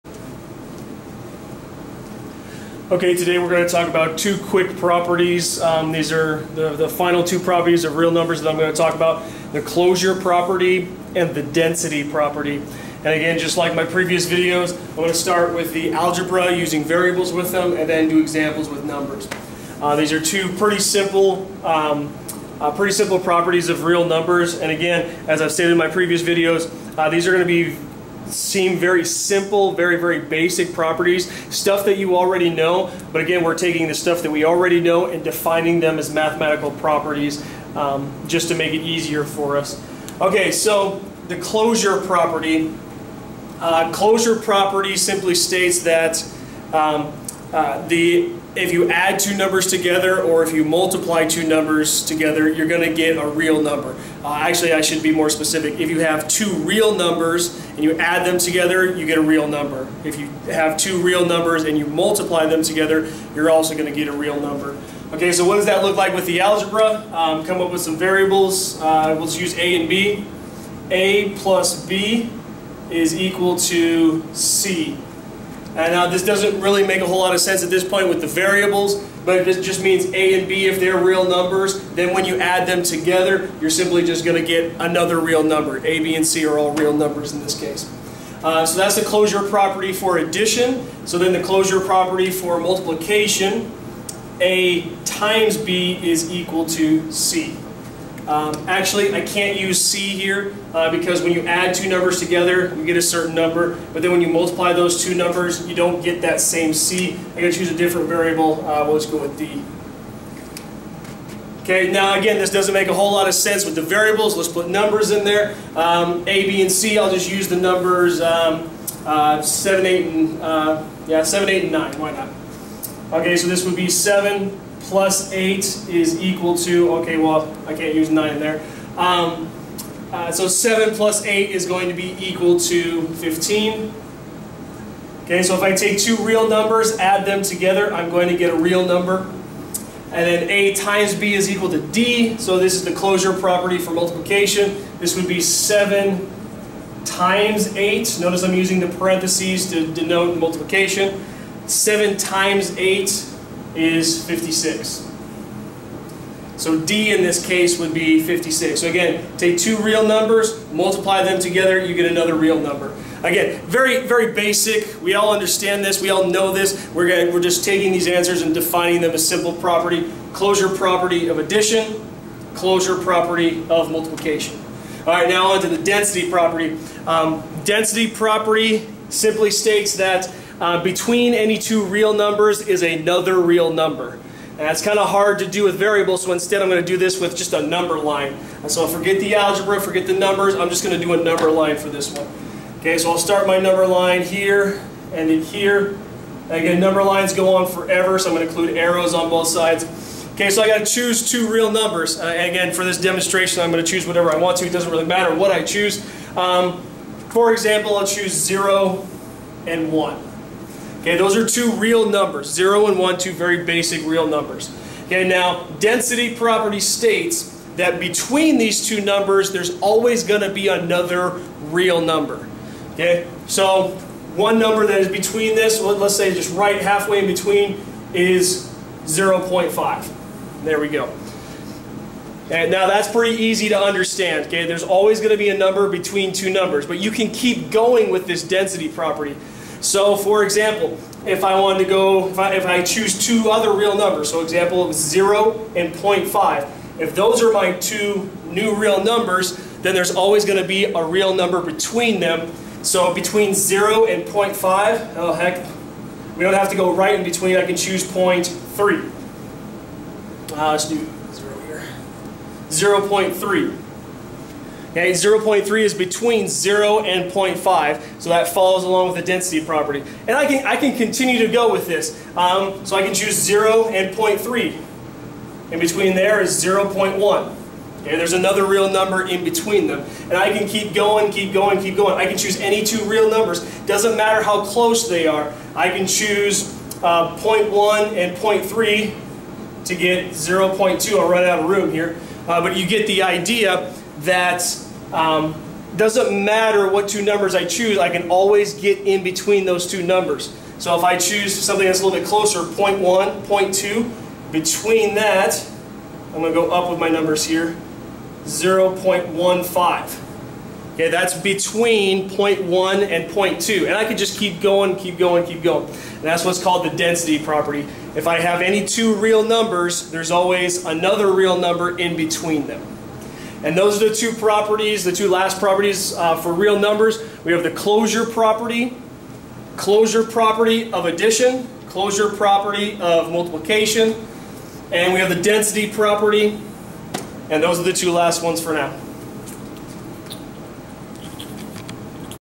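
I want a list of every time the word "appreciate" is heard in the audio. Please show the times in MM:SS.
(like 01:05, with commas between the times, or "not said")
not said.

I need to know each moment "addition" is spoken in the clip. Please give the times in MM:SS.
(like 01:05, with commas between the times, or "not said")
01:30, 02:51, 05:31.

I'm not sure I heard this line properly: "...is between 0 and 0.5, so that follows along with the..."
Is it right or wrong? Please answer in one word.
right.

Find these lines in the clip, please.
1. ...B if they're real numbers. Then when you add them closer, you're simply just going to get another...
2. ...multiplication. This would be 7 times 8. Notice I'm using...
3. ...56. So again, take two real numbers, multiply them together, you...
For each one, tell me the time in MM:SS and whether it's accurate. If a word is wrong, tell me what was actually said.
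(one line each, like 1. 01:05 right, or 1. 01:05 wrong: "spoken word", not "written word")
1. 01:20 wrong: "together", not "closer"
2. 02:23 right
3. 02:38 right.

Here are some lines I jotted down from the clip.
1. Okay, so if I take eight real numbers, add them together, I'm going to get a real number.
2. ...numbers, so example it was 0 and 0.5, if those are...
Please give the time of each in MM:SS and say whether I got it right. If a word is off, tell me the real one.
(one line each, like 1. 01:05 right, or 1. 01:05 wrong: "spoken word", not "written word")
1. 02:15 wrong: "two", not "eight"
2. 04:03 right.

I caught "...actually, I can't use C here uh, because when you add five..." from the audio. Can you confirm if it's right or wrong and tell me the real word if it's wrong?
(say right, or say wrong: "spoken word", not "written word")
wrong: "two", not "five".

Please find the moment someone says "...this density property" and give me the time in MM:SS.
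03:58.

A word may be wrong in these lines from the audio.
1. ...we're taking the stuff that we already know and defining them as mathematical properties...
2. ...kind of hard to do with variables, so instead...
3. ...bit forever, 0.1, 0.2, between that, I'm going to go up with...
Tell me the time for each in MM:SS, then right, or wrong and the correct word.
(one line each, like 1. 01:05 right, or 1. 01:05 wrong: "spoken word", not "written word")
1. 00:33 right
2. 03:04 right
3. 05:02 wrong: "closer", not "forever".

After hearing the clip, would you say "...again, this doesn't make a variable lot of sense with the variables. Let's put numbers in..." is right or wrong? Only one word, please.
wrong.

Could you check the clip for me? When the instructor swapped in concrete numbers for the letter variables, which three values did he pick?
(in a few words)
7, 8, and 9.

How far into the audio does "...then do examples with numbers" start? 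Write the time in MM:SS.
00:17.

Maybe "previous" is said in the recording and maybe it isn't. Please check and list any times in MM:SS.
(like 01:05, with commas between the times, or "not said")
00:13, 00:25.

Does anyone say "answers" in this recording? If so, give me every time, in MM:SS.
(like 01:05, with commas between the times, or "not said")
02:48.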